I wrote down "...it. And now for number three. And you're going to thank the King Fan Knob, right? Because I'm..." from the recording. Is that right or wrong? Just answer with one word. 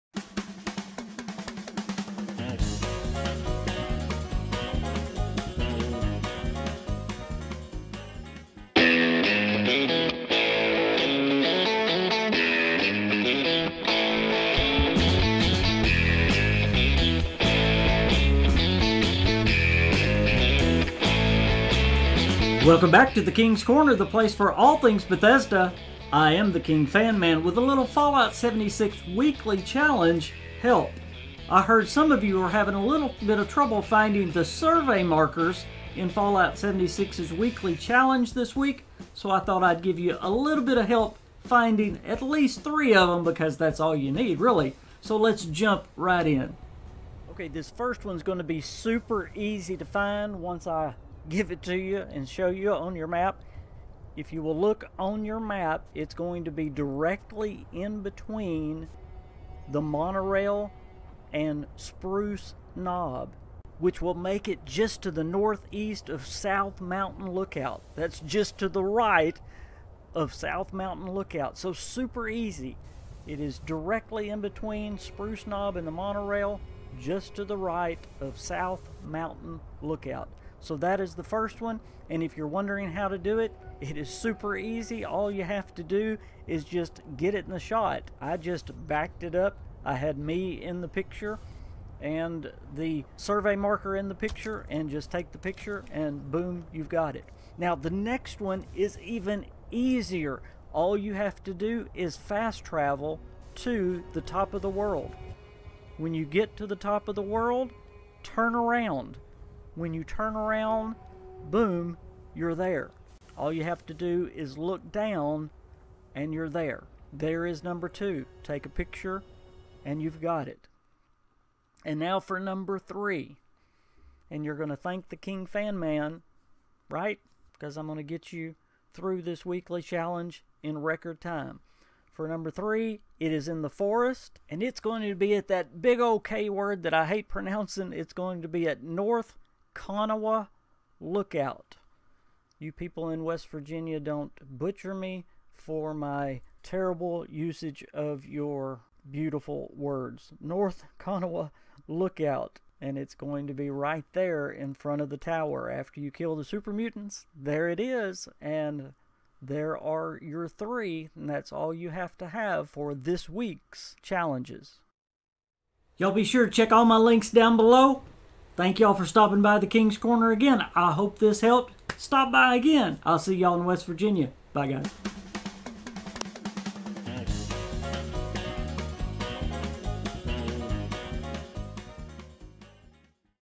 wrong.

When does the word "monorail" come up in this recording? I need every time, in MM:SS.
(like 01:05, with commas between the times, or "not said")
00:59, 01:15.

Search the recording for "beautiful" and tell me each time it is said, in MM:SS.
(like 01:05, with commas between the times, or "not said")
02:29.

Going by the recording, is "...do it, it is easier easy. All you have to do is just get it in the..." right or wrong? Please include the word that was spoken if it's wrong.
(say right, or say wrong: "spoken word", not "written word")
wrong: "super", not "easier".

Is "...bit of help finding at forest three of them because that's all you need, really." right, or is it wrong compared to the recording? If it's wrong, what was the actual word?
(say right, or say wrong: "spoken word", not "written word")
wrong: "least", not "forest".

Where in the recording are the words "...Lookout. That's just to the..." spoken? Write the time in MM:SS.
01:07.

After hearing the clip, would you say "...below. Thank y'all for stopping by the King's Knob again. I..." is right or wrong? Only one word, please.
wrong.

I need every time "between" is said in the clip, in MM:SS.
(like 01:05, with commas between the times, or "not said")
00:58, 01:14.